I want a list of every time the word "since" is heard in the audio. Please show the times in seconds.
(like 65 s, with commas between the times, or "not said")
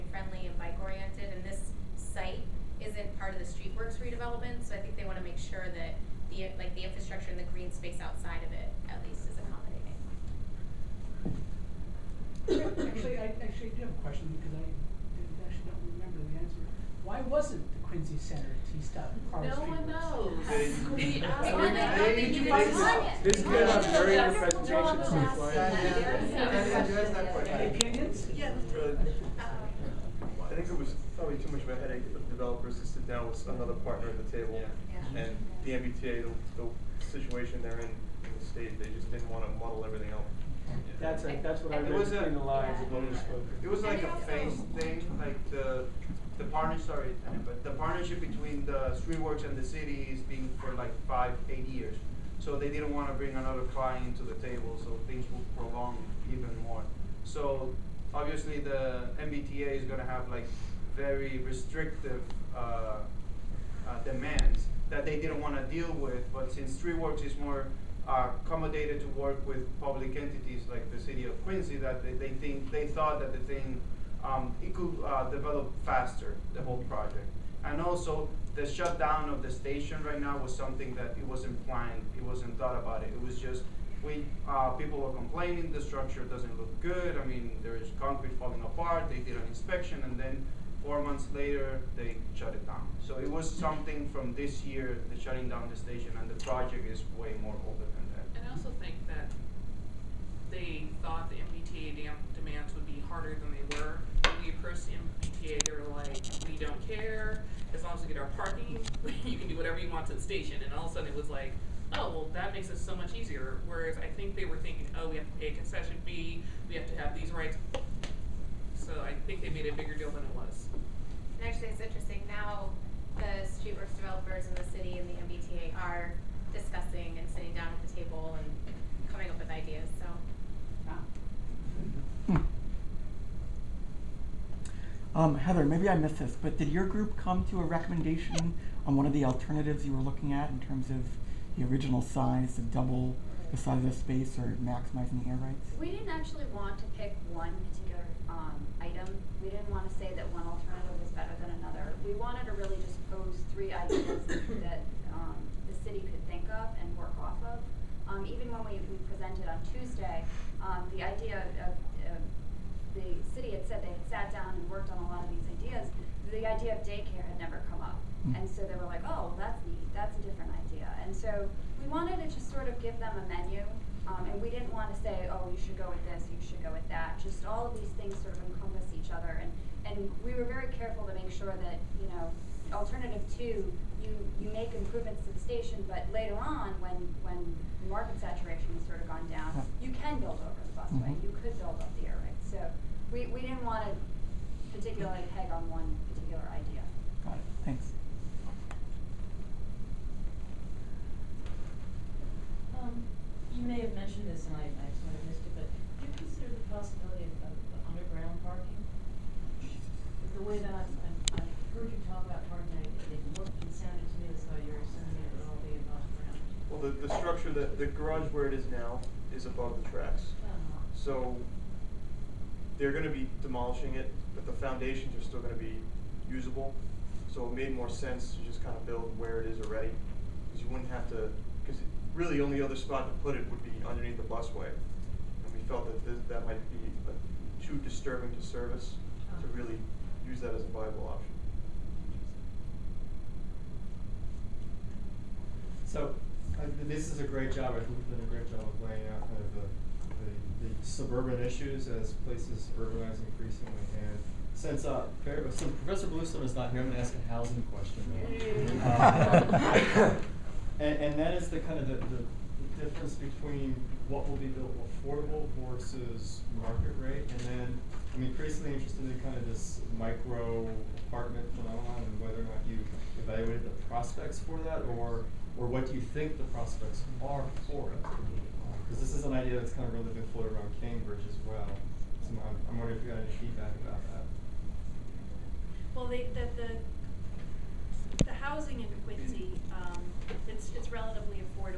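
66 s, 254 s.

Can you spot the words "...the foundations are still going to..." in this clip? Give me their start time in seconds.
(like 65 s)
224 s.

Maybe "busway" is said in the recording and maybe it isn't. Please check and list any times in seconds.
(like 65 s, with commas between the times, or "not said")
190 s, 234 s.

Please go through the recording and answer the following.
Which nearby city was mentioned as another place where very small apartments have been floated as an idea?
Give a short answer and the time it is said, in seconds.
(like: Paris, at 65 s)
Cambridge, at 280 s.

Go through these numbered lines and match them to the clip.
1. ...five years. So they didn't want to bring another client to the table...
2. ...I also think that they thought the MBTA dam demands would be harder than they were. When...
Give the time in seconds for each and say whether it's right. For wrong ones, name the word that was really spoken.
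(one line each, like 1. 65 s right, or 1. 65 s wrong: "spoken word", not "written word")
1. 51 s wrong: "eight", not "five"
2. 98 s right.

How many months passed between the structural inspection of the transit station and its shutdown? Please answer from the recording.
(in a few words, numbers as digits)
4.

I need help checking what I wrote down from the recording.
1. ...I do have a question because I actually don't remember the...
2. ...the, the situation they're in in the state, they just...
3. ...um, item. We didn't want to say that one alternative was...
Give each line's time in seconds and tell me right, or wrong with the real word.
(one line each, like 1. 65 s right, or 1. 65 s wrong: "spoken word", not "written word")
1. 13 s right
2. 36 s right
3. 148 s right.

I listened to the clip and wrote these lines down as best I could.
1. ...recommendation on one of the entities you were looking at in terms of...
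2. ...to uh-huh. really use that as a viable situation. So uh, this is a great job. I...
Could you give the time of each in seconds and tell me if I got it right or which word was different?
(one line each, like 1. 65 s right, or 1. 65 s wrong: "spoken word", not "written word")
1. 137 s wrong: "alternatives", not "entities"
2. 239 s wrong: "option", not "situation".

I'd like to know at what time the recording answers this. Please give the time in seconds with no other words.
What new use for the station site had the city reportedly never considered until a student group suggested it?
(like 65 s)
166 s.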